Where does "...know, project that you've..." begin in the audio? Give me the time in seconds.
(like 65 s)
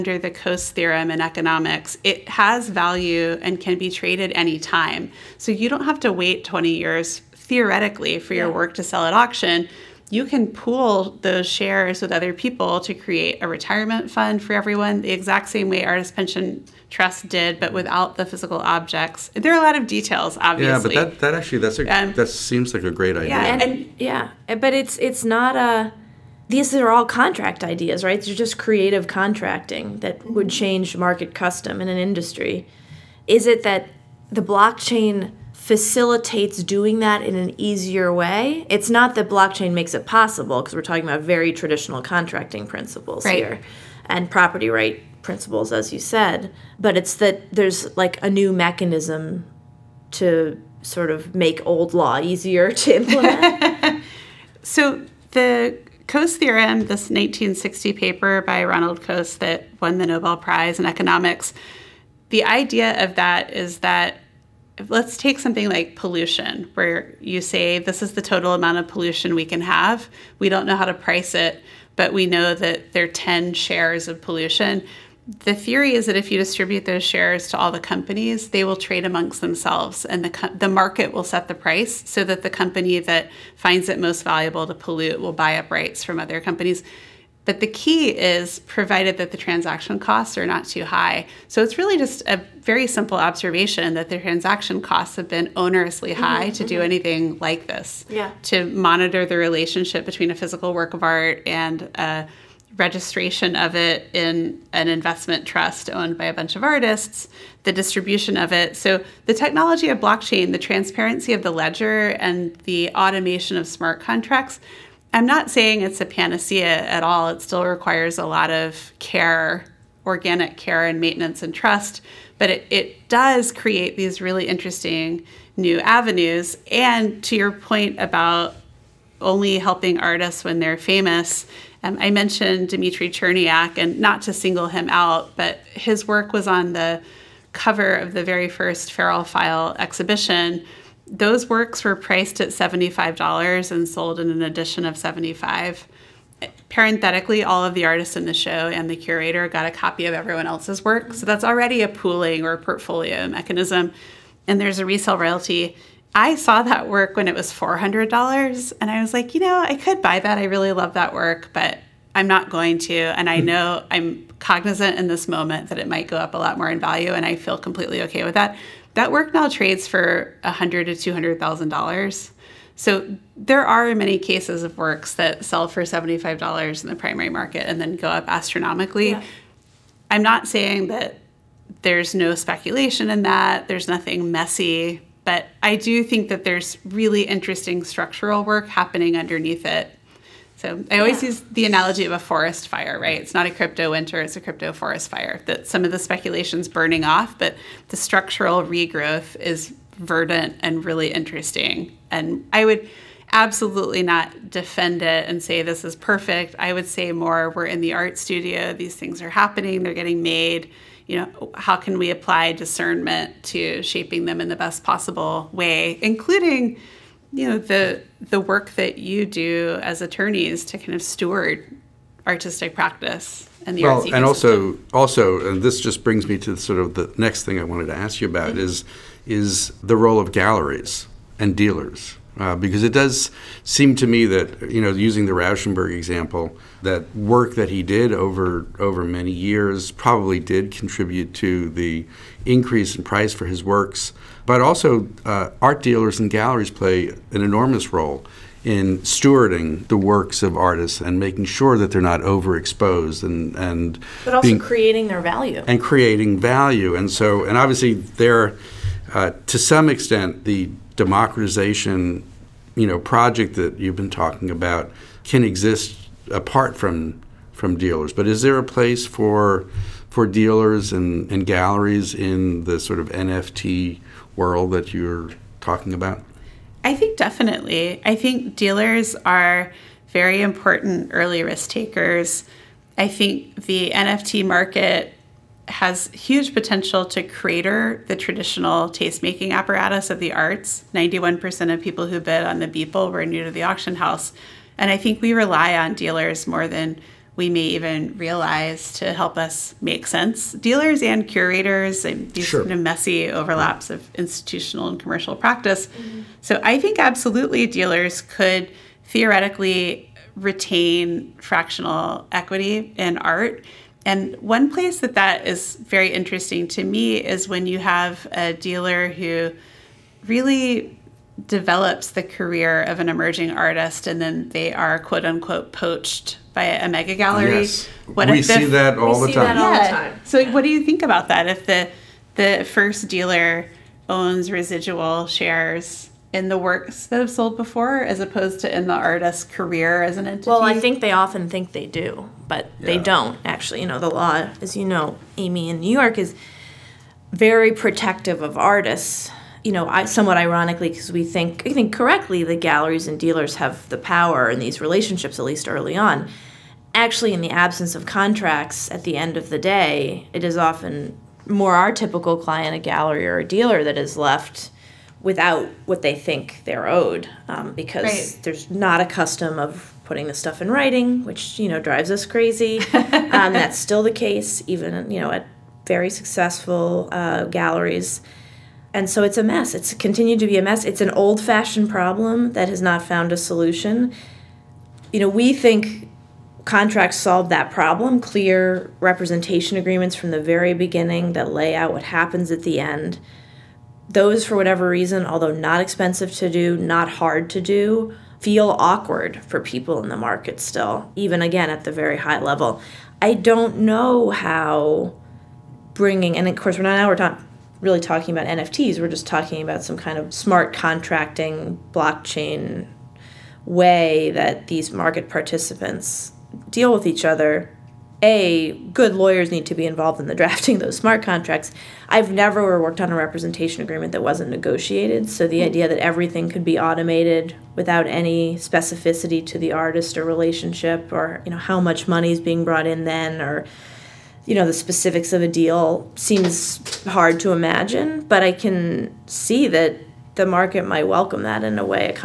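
262 s.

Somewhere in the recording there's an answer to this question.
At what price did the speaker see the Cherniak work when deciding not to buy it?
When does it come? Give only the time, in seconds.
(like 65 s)
157 s.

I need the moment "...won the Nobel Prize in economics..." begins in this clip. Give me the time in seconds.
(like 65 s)
59 s.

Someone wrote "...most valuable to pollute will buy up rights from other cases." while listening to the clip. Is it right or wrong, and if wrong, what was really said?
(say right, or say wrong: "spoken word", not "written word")
wrong: "companies", not "cases".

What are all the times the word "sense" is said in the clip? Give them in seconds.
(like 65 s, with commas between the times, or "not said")
300 s.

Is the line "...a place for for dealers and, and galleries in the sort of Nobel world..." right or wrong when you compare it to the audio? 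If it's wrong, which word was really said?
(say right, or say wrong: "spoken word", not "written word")
wrong: "NFT", not "Nobel".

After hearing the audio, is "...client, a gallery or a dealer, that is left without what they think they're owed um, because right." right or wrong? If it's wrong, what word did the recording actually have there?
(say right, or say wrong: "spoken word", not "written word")
right.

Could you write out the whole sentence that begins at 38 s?
It's not that blockchain makes it possible because we're talking about very traditional contracting principles right.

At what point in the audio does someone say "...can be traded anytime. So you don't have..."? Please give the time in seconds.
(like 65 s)
3 s.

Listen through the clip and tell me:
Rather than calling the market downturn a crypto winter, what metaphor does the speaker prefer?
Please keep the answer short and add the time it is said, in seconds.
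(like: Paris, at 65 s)
crypto forest fire, at 194 s.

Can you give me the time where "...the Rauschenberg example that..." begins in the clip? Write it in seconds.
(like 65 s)
235 s.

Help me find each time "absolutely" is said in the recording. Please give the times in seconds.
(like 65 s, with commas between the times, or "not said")
203 s, 306 s.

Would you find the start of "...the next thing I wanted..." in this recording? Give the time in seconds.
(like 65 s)
226 s.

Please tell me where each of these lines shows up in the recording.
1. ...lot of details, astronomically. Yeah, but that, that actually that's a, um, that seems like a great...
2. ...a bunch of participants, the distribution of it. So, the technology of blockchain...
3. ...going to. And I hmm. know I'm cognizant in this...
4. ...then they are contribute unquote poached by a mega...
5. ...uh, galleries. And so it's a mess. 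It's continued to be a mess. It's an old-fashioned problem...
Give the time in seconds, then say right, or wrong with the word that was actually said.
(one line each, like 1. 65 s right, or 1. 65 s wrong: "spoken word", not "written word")
1. 19 s wrong: "obviously", not "astronomically"
2. 106 s wrong: "artists", not "participants"
3. 162 s right
4. 324 s wrong: "quote", not "contribute"
5. 377 s right.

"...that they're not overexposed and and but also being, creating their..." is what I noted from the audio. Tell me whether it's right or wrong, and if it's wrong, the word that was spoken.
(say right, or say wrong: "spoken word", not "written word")
right.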